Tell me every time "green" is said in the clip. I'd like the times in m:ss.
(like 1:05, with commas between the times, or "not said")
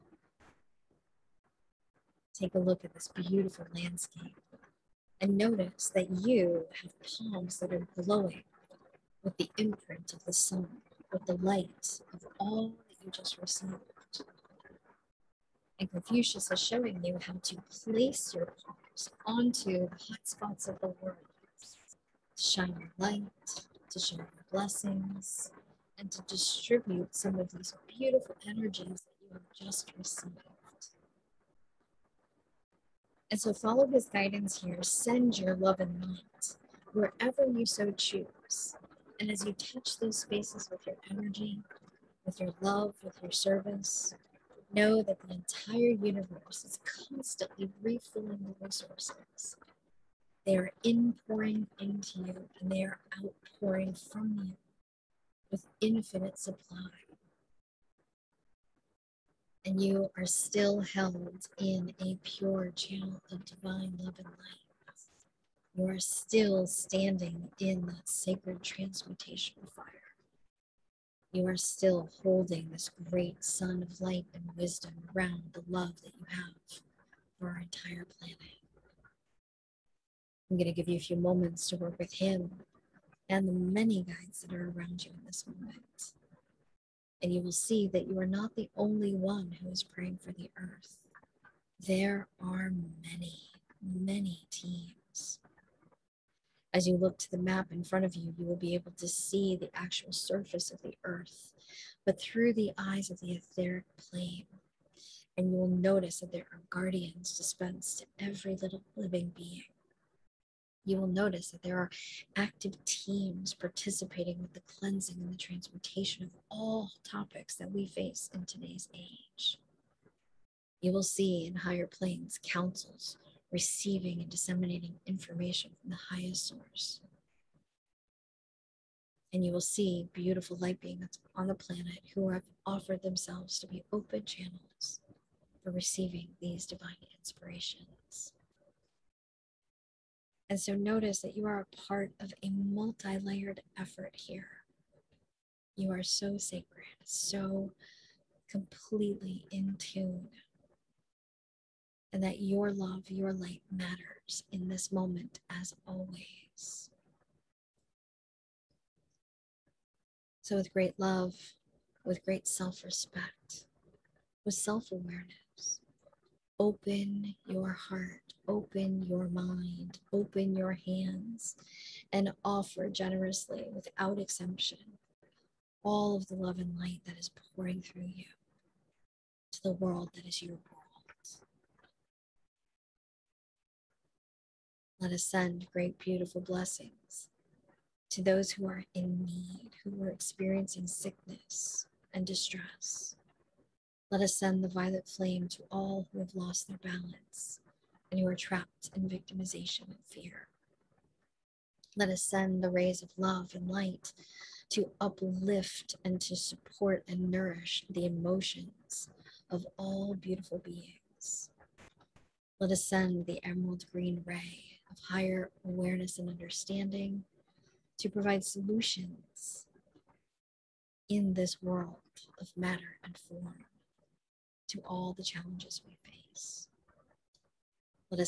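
3:33.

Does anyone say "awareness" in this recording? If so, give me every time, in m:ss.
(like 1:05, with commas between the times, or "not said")
2:44, 3:35.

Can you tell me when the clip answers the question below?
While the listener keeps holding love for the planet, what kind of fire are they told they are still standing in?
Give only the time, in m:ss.
1:08.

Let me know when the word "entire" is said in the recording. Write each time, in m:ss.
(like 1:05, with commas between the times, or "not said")
0:45, 1:17.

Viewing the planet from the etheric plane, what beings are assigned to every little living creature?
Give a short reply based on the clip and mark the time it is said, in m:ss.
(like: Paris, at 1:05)
Guardians, at 1:46.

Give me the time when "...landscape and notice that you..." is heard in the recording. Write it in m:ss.
0:03.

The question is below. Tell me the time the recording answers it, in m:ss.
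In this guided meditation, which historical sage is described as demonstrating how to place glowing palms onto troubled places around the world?
0:15.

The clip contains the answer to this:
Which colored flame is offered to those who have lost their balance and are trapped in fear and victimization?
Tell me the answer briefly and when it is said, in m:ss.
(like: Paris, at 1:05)
Violet flame, at 3:14.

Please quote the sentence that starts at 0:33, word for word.
And so follow his guidance here.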